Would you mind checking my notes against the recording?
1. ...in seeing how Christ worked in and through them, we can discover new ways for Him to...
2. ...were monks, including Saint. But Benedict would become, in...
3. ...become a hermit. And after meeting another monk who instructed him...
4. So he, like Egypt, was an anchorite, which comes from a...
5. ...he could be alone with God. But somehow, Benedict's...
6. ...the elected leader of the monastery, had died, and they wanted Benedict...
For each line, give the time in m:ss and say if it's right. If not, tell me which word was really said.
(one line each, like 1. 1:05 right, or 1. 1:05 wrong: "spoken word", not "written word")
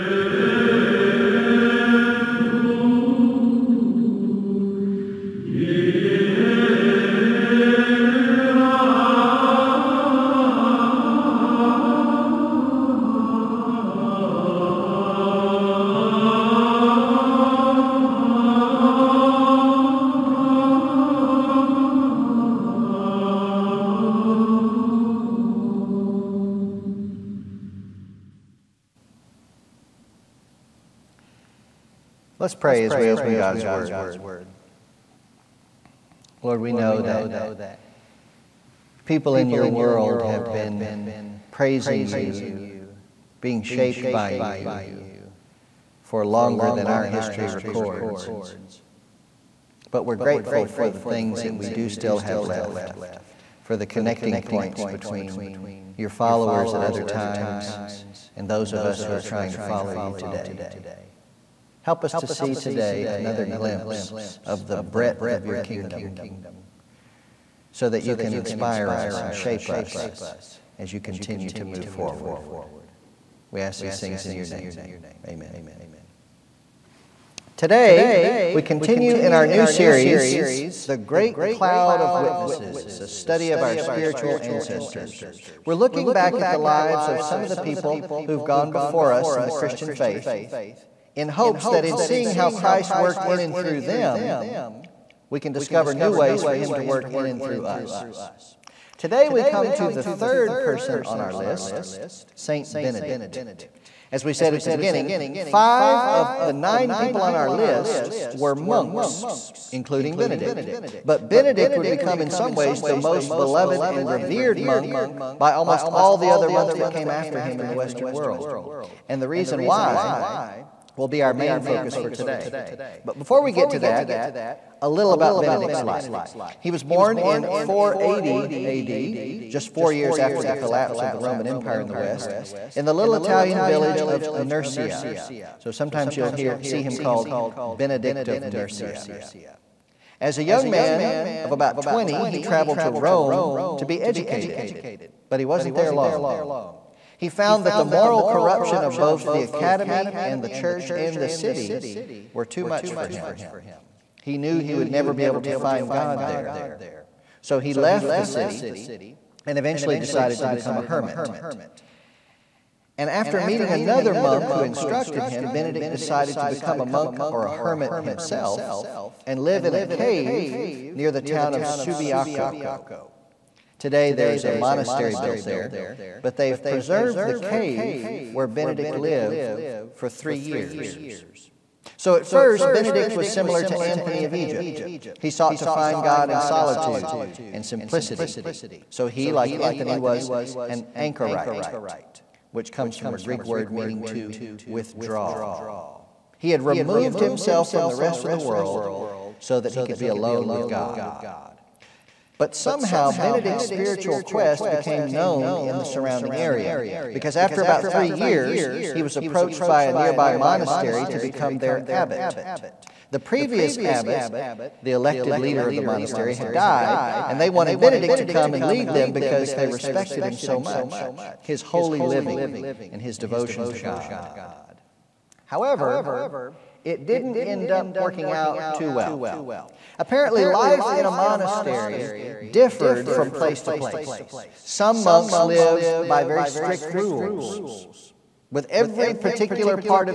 1. 1:31 right
2. 1:48 wrong: "Benedict", not "Saint"
3. 2:40 right
4. 3:08 wrong: "Anthony", not "Egypt"
5. 3:19 right
6. 3:34 right.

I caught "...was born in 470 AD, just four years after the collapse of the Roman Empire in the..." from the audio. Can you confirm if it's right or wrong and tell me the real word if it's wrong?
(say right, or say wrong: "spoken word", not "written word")
wrong: "480", not "470".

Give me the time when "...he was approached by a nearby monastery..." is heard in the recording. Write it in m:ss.
3:28.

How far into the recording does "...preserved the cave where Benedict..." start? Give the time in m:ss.
2:56.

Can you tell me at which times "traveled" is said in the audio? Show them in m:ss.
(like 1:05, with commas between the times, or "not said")
2:22.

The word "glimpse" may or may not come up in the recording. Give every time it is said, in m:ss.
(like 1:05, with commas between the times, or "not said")
1:03.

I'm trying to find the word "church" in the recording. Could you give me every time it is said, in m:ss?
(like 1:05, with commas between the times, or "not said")
2:30.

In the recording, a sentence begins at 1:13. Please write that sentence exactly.
We ask these things in your name.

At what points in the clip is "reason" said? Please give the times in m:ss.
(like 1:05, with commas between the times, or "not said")
1:59.